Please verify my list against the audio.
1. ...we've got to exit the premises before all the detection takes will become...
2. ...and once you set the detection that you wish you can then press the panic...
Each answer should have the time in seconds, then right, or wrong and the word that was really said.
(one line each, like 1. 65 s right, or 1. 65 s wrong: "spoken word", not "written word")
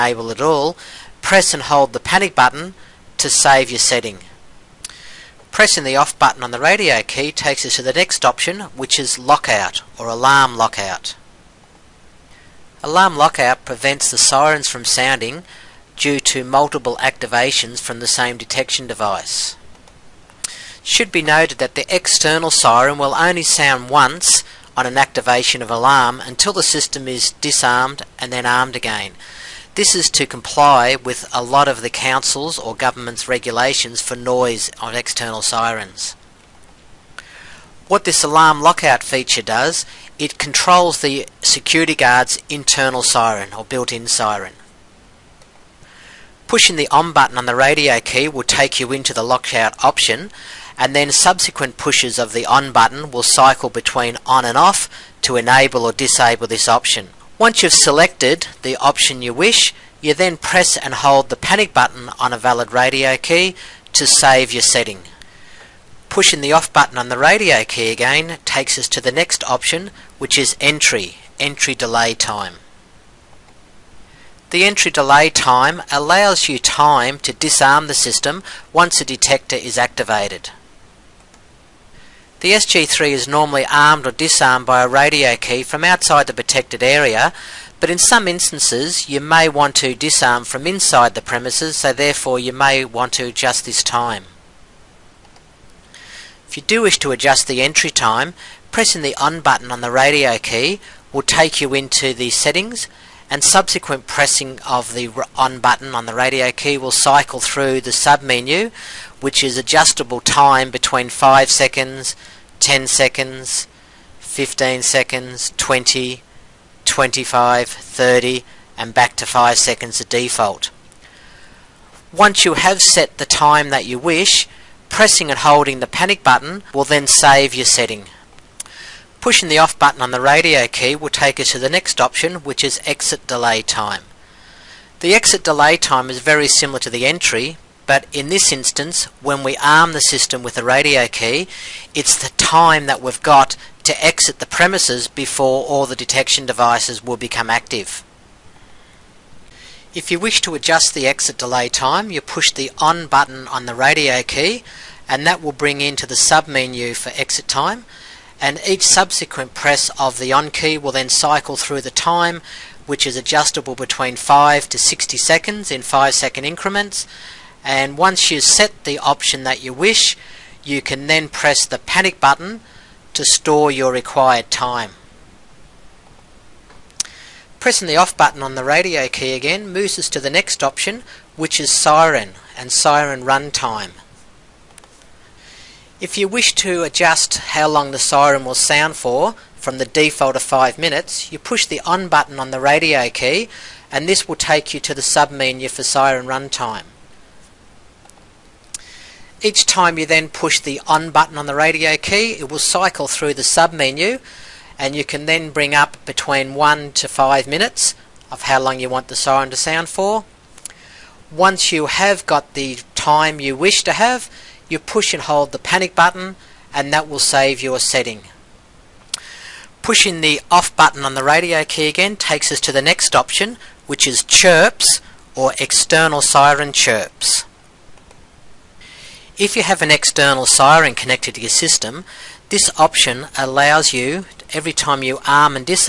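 1. 143 s wrong: "devices", not "takes"
2. 167 s wrong: "option", not "detection".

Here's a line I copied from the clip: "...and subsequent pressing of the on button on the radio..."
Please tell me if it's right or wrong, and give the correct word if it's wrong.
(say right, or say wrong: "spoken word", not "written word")
right.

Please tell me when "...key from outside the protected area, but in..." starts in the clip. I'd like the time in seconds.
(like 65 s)
85 s.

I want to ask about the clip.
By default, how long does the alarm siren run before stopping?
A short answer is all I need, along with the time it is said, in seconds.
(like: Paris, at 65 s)
5 minutes, at 189 s.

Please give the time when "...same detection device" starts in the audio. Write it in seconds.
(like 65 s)
18 s.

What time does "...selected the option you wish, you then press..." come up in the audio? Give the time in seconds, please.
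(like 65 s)
57 s.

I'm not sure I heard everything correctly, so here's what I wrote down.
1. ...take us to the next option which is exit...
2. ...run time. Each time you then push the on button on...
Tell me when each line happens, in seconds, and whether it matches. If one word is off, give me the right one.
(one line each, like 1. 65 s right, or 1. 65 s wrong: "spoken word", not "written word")
1. 131 s right
2. 196 s right.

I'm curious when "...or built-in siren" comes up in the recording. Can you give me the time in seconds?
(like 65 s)
43 s.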